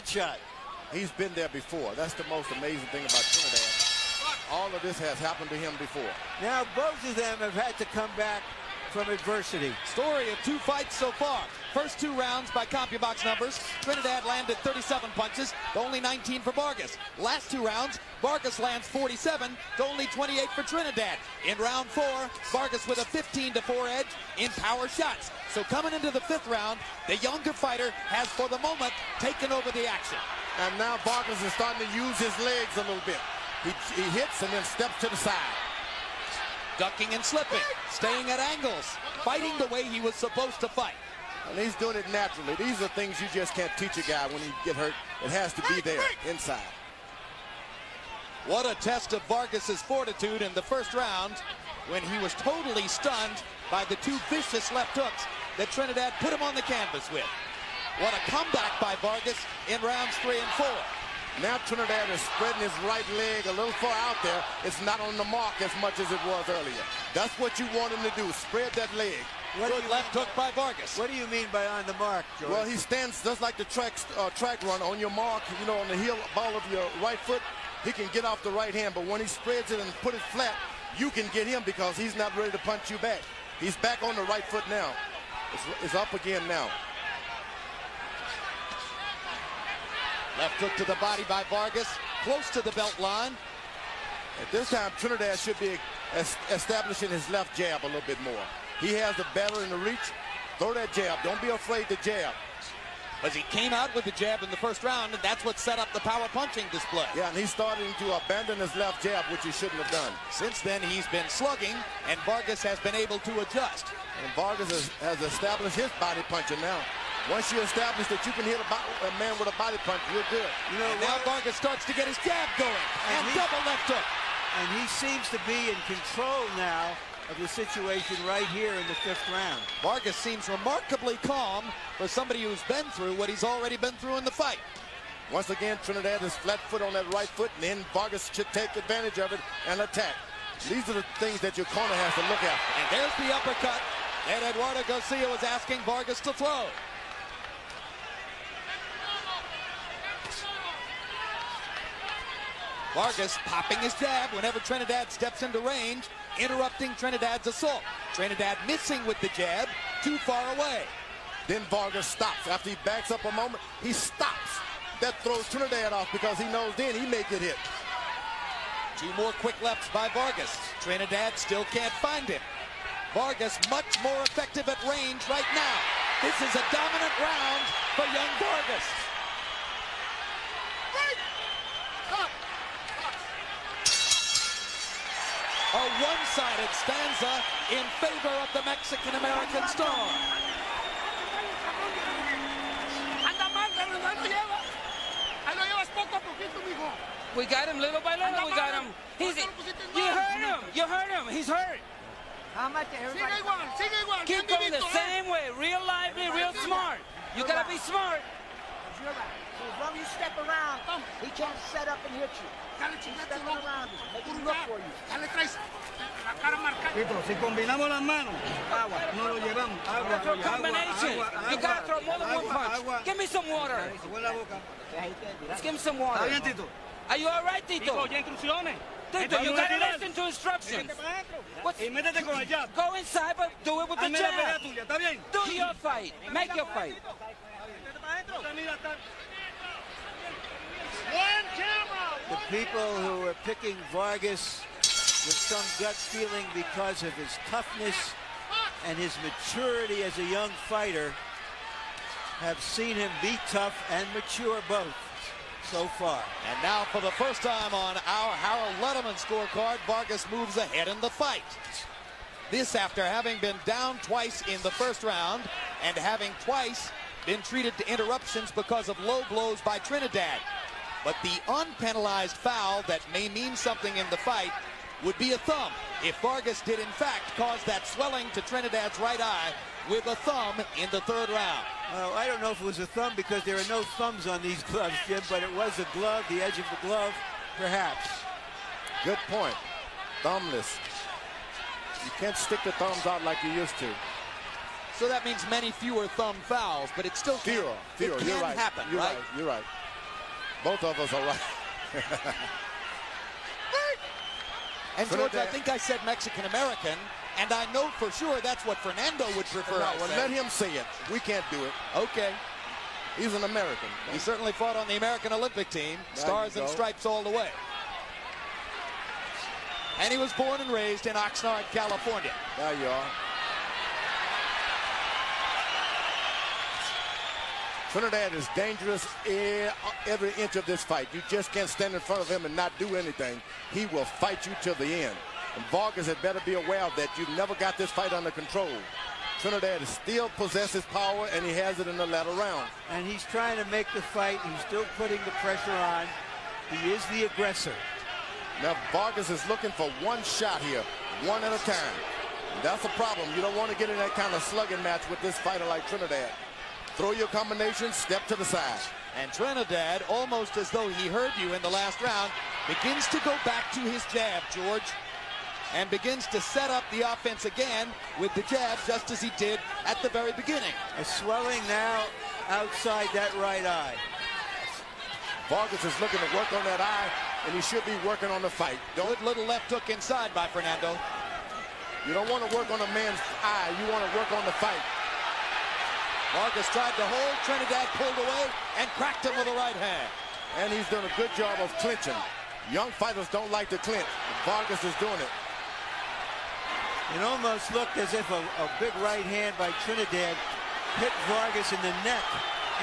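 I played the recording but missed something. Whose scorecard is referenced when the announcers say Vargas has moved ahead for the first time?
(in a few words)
Harold Lederman.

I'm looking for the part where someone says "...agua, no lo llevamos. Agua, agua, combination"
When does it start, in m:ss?
3:38.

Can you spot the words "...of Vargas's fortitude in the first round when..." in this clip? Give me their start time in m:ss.
0:49.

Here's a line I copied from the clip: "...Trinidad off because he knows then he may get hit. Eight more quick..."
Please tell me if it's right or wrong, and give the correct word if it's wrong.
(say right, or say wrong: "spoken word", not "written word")
wrong: "Two", not "Eight".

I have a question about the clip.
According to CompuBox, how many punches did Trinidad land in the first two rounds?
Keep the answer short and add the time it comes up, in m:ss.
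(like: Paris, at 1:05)
37, at 0:14.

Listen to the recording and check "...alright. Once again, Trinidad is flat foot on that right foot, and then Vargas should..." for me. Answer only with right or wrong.
wrong.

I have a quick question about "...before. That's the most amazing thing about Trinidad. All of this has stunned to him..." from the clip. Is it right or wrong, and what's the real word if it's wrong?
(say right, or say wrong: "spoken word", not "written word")
wrong: "happened", not "stunned".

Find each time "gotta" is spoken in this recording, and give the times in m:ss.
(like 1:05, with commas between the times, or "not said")
3:27, 3:41, 3:49.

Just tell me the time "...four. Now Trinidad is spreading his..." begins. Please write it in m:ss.
1:00.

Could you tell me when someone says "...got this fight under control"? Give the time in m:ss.
5:37.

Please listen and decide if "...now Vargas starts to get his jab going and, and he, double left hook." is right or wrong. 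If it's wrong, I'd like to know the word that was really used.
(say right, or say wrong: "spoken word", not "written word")
right.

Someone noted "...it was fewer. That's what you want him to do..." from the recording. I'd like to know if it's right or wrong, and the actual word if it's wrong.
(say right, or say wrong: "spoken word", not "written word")
wrong: "earlier", not "fewer".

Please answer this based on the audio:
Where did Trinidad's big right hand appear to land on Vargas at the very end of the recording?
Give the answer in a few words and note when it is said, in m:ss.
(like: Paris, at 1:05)
the neck, at 6:42.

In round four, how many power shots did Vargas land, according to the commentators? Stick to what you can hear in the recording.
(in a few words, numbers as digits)
15.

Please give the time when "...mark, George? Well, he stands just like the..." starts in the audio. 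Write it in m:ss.
1:11.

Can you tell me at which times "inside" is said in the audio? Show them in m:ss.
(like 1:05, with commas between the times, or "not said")
0:46, 3:52, 6:19.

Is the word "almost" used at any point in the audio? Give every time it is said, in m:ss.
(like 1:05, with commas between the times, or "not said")
6:00, 6:37.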